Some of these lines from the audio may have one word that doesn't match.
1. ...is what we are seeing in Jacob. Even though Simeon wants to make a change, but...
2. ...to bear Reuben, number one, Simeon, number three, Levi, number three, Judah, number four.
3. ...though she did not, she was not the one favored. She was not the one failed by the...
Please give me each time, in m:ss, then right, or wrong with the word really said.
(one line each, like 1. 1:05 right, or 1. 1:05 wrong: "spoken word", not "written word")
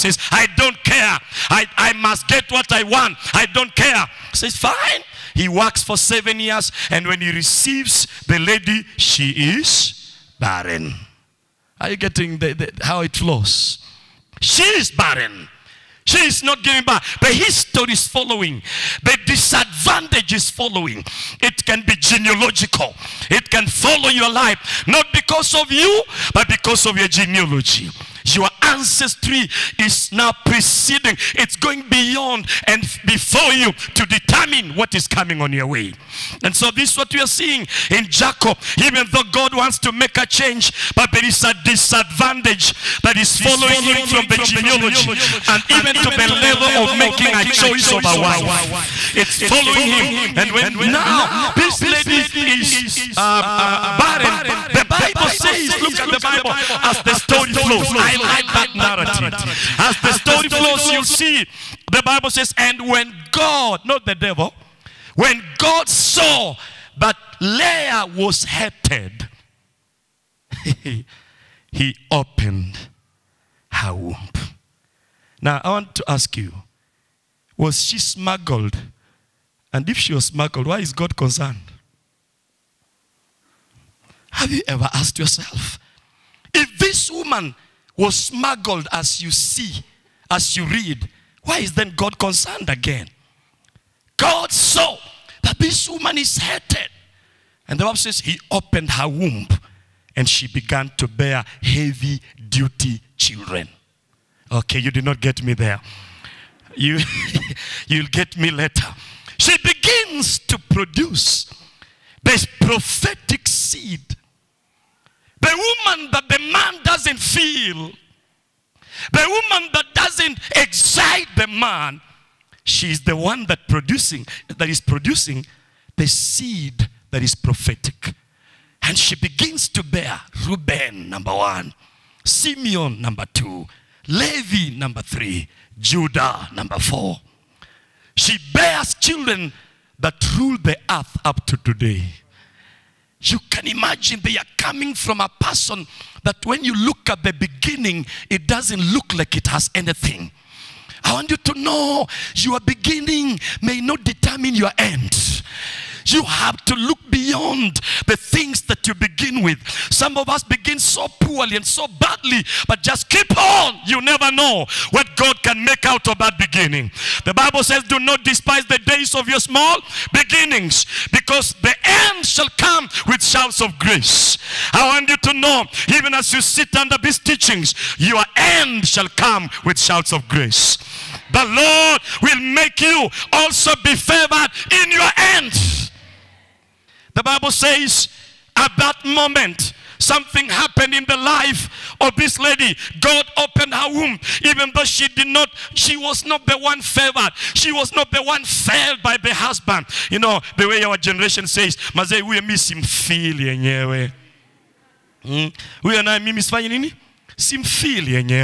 1. 0:36 wrong: "God", not "Simeon"
2. 2:09 wrong: "two", not "three"
3. 3:14 right.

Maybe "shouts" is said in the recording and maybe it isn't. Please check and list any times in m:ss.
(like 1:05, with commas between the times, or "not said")
2:53, 2:59.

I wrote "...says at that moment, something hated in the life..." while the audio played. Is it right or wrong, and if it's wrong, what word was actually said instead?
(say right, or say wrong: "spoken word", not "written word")
wrong: "happened", not "hated".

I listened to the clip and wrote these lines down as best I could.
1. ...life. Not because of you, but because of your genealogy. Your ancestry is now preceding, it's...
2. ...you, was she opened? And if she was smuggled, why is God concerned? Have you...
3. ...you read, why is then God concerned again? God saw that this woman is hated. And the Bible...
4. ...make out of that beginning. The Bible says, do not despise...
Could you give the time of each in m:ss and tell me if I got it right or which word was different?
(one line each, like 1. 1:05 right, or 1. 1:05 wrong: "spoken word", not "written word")
1. 0:24 right
2. 1:16 wrong: "smuggled", not "opened"
3. 1:30 right
4. 2:45 right.